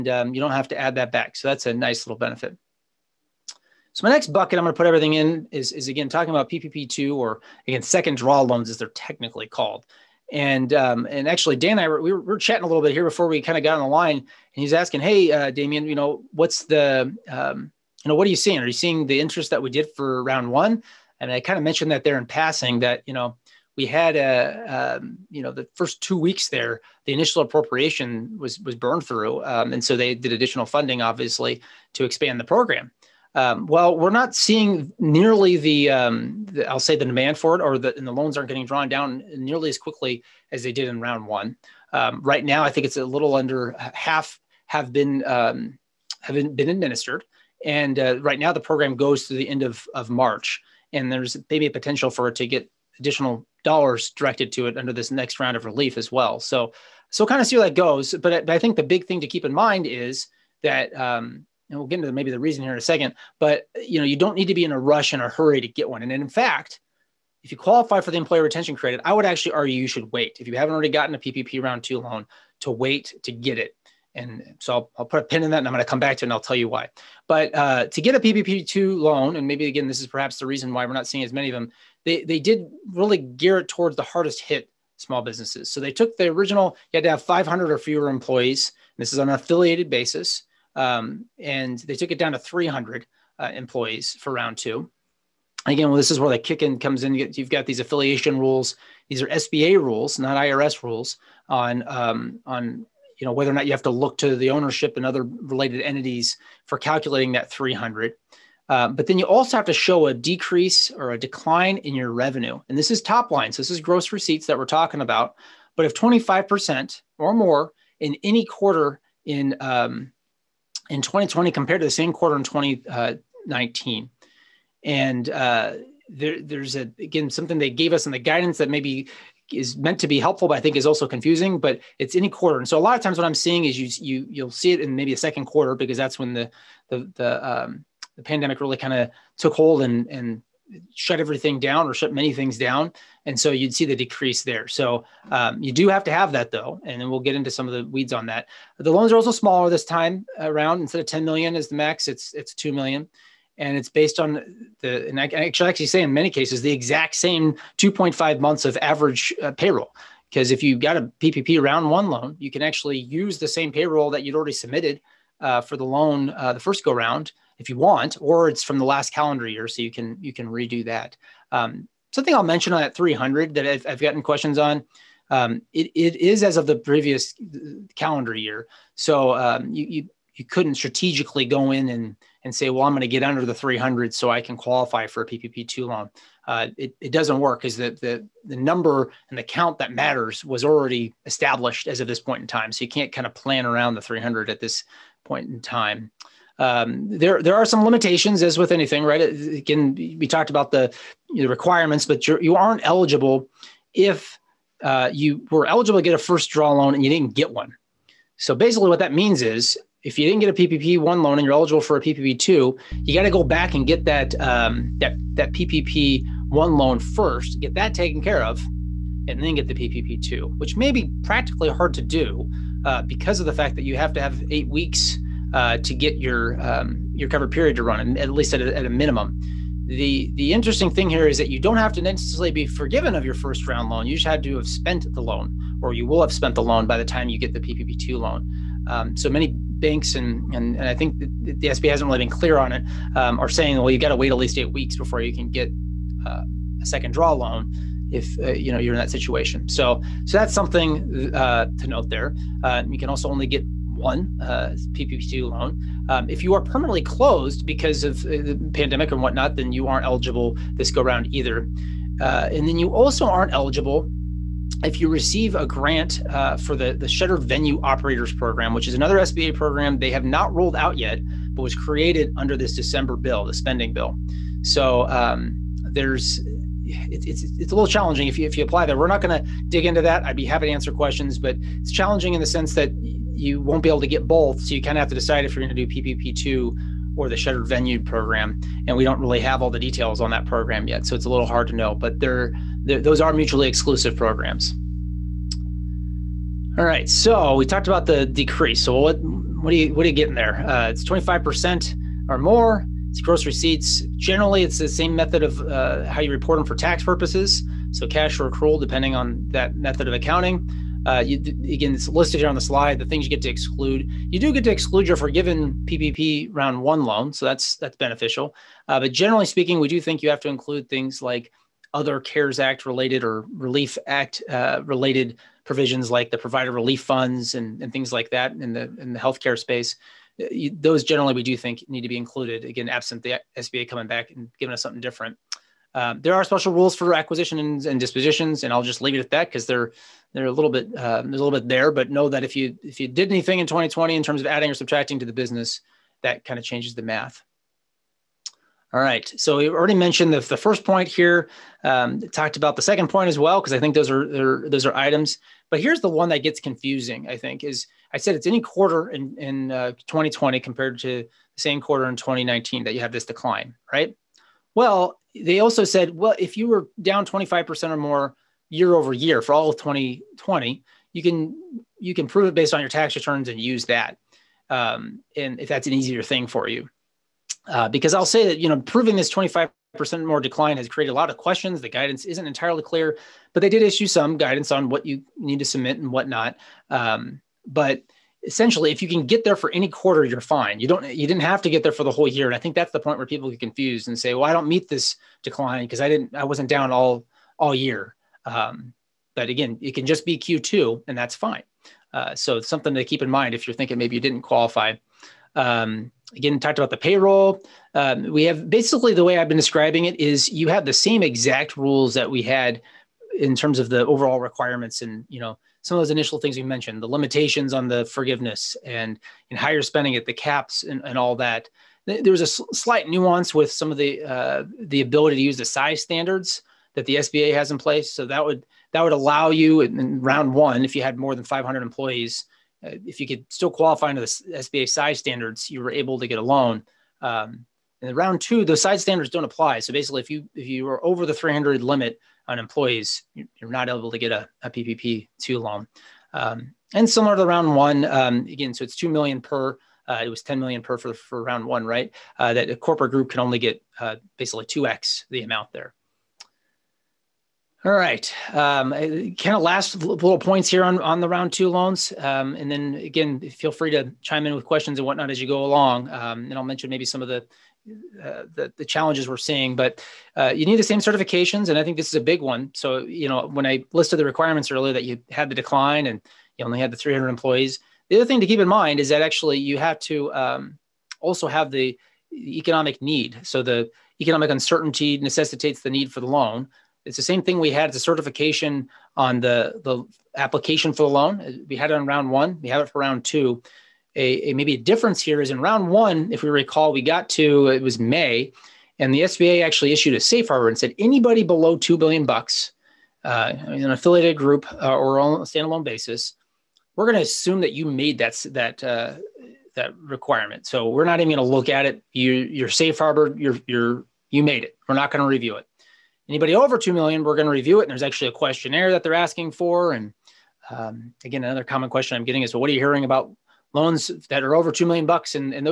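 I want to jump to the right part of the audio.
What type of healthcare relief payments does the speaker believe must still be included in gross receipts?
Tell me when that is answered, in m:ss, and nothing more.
5:26.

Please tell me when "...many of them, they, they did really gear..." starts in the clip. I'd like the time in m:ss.
1:21.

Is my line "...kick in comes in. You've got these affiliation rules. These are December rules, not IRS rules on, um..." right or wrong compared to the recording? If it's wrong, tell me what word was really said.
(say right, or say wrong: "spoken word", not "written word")
wrong: "SBA", not "December".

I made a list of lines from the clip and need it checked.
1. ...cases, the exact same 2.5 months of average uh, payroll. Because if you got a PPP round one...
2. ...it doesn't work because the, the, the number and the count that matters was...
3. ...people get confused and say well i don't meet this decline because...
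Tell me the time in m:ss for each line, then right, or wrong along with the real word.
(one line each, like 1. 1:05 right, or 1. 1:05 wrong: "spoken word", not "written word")
1. 2:36 right
2. 3:06 right
3. 6:33 right.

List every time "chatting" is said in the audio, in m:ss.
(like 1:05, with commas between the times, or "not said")
0:12.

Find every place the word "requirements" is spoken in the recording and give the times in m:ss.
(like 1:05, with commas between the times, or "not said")
3:21, 6:54, 7:54, 8:29.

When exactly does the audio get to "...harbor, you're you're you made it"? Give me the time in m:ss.
8:32.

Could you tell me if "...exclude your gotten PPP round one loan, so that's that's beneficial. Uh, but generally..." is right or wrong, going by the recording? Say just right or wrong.
wrong.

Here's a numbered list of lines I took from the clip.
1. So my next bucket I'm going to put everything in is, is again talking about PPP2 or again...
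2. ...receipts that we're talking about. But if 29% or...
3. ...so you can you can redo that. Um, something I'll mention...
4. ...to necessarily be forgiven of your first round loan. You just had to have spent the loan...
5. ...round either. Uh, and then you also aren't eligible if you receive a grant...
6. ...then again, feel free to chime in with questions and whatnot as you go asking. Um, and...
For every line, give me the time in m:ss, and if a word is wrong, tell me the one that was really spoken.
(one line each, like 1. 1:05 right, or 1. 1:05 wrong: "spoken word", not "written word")
1. 0:03 right
2. 1:54 wrong: "25", not "29"
3. 2:49 right
4. 3:51 right
5. 4:21 right
6. 7:42 wrong: "along", not "asking".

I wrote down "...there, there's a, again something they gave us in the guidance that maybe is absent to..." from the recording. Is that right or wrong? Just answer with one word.
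wrong.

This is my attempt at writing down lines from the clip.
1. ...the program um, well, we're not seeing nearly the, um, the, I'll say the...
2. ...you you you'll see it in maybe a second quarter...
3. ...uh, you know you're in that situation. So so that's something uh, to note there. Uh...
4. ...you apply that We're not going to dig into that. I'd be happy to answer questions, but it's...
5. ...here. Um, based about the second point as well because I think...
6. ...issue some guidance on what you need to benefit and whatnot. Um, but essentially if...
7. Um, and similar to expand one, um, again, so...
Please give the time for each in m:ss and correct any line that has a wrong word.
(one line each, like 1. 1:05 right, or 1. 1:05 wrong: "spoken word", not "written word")
1. 0:32 right
2. 2:13 right
3. 4:08 right
4. 4:38 right
5. 5:51 wrong: "talked", not "based"
6. 6:23 wrong: "submit", not "benefit"
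7. 7:26 wrong: "round", not "expand".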